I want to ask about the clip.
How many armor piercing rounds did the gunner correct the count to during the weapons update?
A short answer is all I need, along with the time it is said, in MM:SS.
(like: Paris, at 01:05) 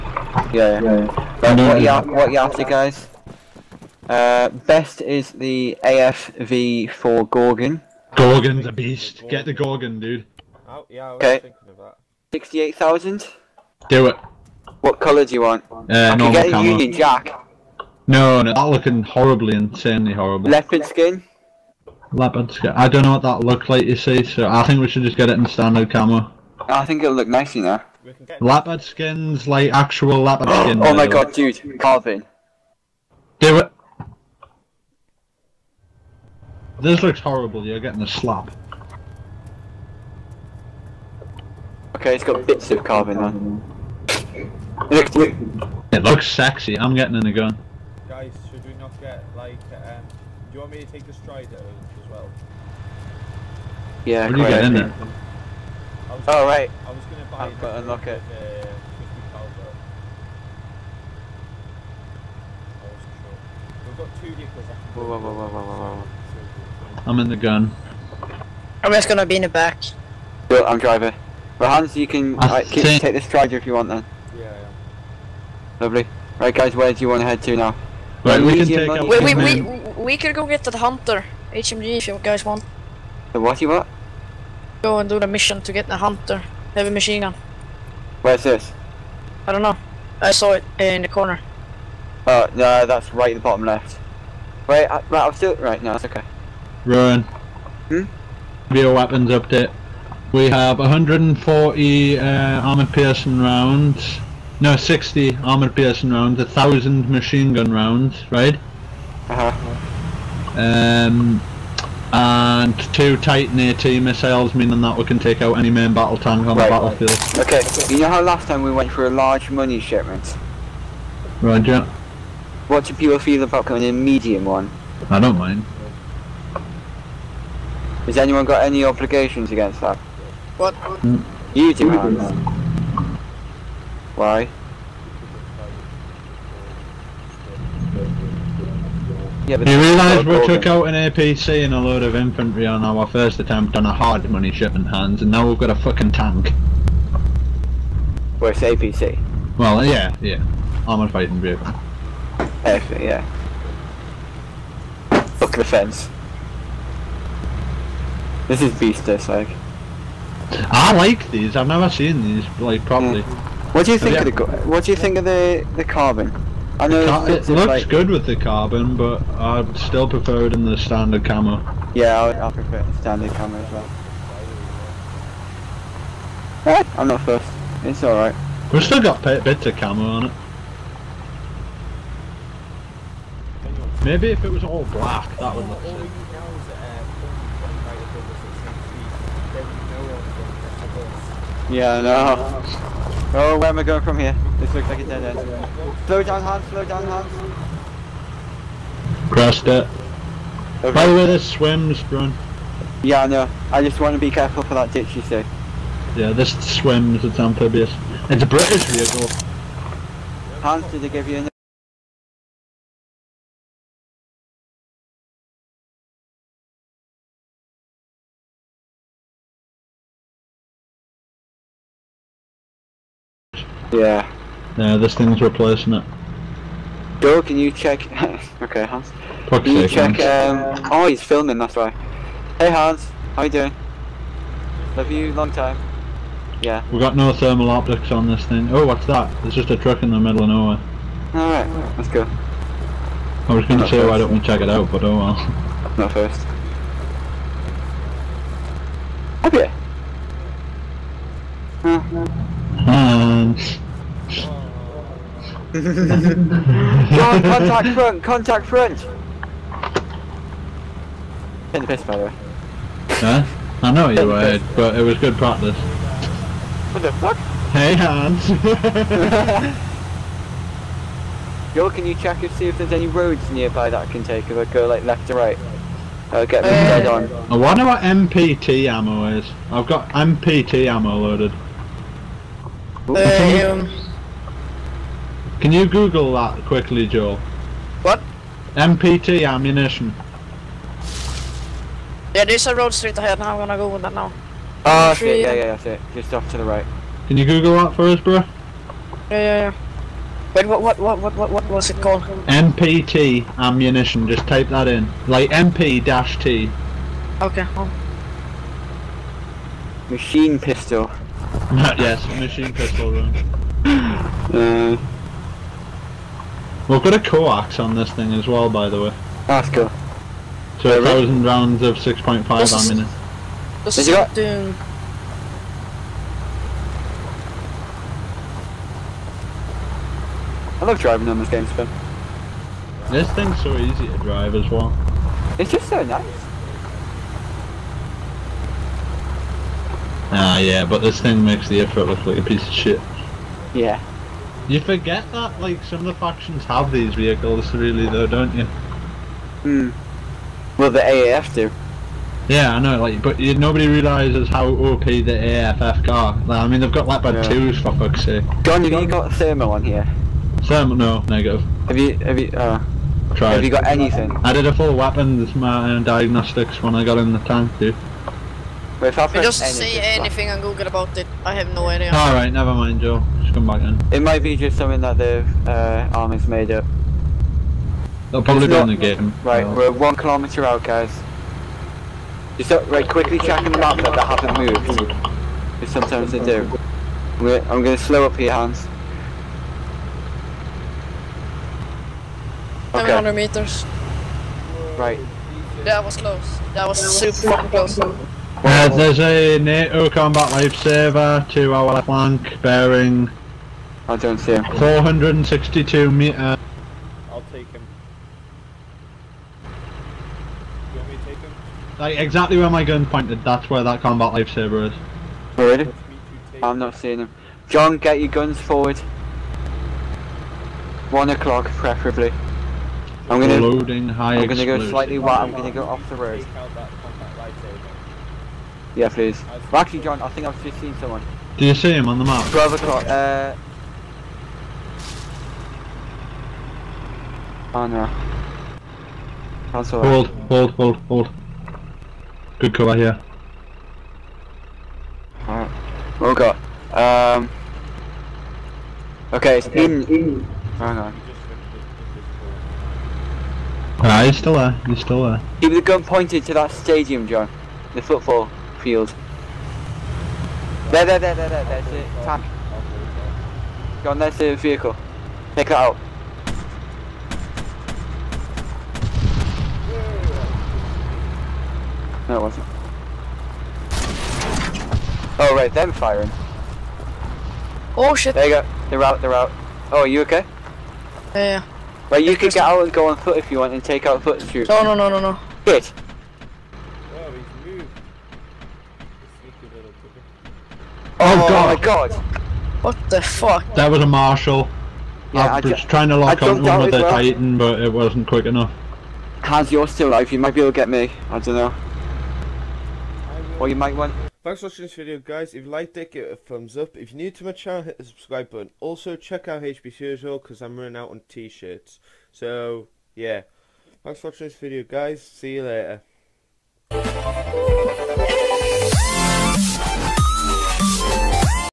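60, at 01:44.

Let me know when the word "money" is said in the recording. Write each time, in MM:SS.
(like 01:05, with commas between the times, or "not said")
01:59, 02:24.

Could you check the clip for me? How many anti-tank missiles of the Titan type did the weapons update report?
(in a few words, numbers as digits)
2.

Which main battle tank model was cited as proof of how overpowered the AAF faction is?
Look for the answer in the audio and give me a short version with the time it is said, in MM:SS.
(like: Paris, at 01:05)
Leopard 2, at 05:57.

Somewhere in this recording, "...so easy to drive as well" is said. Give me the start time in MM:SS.
05:33.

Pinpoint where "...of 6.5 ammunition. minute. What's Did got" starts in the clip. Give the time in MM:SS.
05:21.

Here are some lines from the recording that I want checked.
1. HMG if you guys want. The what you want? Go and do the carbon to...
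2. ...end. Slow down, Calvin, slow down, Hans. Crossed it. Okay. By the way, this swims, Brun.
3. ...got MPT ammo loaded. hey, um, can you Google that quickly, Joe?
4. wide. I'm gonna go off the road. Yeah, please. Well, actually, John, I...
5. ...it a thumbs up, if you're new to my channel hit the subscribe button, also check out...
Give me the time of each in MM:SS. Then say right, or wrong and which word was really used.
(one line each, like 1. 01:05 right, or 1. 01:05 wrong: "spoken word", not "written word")
1. 01:21 wrong: "mission", not "carbon"
2. 03:15 wrong: "Hans", not "Calvin"
3. 04:39 right
4. 07:05 right
5. 08:26 right.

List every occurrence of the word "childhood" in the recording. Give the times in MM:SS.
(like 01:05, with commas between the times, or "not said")
not said.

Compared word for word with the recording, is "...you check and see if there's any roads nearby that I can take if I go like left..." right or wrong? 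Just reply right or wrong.
right.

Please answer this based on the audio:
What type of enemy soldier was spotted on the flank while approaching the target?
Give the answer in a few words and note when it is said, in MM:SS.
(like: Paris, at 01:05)
NATO combat lifesaver, at 06:39.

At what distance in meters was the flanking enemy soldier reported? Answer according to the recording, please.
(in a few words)
462.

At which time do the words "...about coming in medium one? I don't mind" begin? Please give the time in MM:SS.
02:03.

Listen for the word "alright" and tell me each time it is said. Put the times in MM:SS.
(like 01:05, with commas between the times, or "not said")
02:58, 04:01, 06:12, 07:25.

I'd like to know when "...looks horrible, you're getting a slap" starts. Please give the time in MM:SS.
00:37.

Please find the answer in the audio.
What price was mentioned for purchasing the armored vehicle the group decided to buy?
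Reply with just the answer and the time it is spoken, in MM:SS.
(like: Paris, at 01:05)
68,000, at 00:12.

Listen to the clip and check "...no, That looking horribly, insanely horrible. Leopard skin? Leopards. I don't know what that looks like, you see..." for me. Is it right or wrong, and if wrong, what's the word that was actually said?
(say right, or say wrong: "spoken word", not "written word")
right.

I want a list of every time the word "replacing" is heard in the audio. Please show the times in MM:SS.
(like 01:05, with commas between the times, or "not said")
03:45.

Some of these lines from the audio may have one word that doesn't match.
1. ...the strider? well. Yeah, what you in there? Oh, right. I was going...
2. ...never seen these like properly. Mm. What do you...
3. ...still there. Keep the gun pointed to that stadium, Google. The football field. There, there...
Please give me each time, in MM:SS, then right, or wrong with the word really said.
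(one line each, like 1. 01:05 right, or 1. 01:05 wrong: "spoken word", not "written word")
1. 00:51 right
2. 02:41 right
3. 07:34 wrong: "John", not "Google".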